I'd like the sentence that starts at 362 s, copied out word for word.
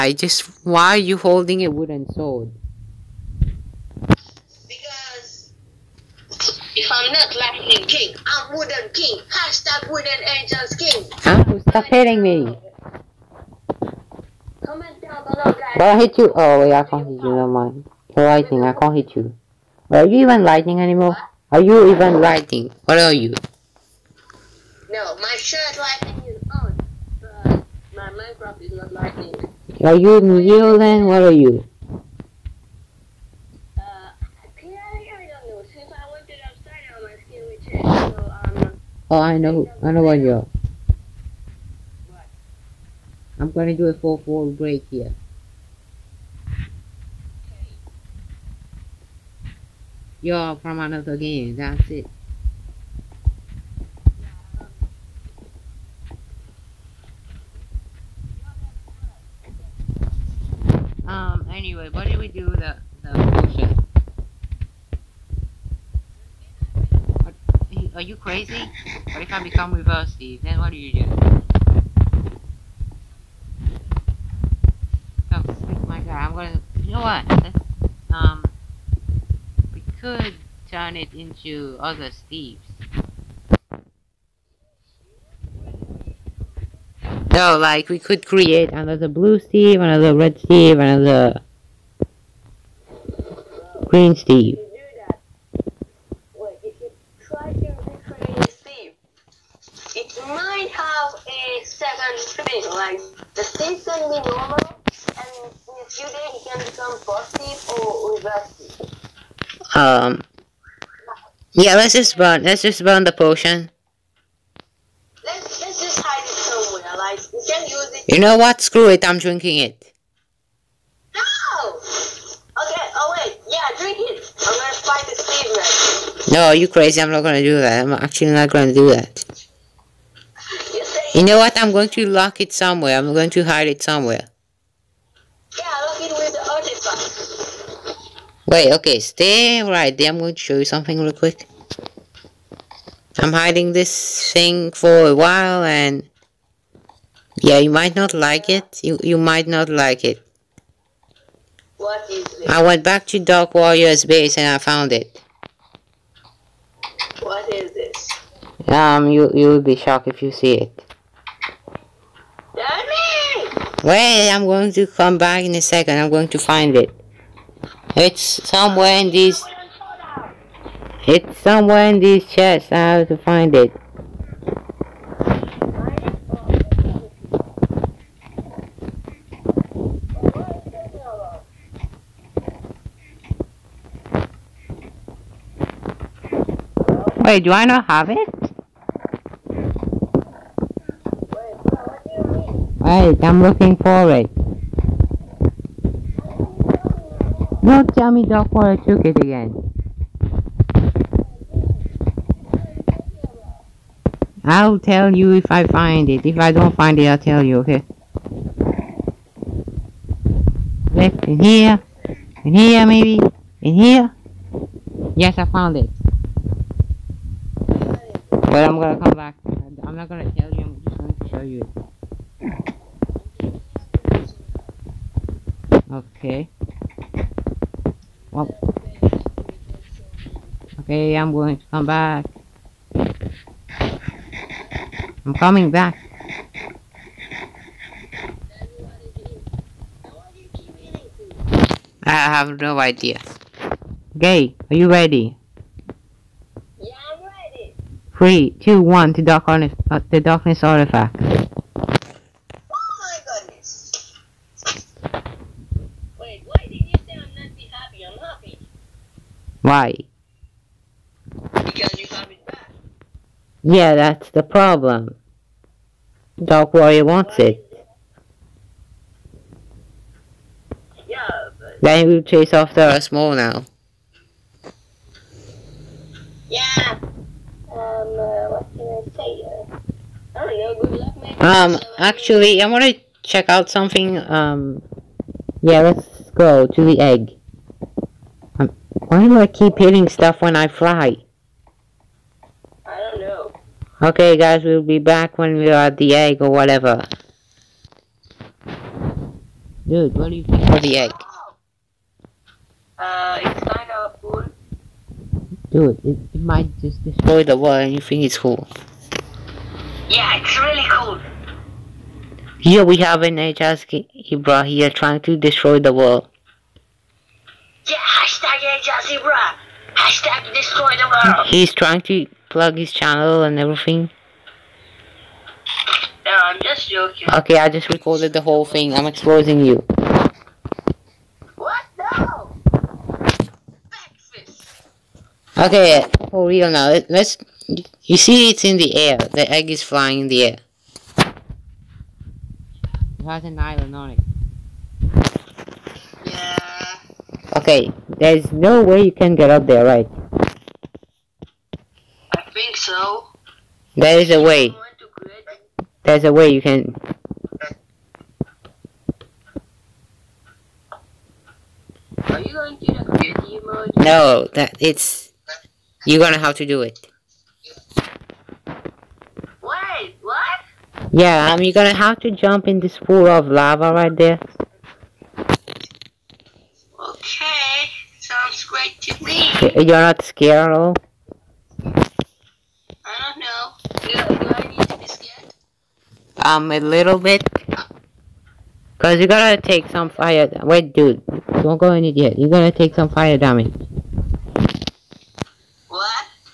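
Are you going to the mode?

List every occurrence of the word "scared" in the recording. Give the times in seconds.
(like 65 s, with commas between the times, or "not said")
380 s, 385 s.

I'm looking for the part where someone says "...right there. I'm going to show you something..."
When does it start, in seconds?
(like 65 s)
139 s.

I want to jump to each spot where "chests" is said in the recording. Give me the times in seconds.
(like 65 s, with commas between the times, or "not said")
172 s.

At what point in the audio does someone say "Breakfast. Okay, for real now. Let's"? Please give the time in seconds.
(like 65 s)
333 s.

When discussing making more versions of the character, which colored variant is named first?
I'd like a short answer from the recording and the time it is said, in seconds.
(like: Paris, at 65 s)
Blue Steve, at 89 s.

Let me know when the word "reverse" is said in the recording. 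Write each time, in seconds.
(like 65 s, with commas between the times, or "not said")
69 s, 108 s.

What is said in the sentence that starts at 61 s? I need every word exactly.
Um, anyway, what did we do with the, the bullshit?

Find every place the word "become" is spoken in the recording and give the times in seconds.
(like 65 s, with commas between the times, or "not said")
69 s, 106 s.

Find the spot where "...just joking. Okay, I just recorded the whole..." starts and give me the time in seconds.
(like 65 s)
326 s.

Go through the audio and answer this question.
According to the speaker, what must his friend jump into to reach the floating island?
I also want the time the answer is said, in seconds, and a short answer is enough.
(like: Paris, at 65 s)
Pool of lava, at 372 s.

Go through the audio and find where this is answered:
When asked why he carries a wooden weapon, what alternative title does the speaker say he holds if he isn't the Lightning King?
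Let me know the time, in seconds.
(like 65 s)
8 s.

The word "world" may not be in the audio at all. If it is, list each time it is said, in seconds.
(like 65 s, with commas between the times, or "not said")
307 s, 315 s, 321 s.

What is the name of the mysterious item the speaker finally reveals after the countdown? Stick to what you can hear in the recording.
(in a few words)
Darkness artifact.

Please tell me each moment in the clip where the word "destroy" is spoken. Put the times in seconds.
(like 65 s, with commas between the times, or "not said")
307 s, 315 s, 320 s.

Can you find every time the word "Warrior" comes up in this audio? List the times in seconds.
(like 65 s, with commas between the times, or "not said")
153 s, 266 s.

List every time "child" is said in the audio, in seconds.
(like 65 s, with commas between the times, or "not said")
not said.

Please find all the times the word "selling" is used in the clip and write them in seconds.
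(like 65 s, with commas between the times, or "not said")
not said.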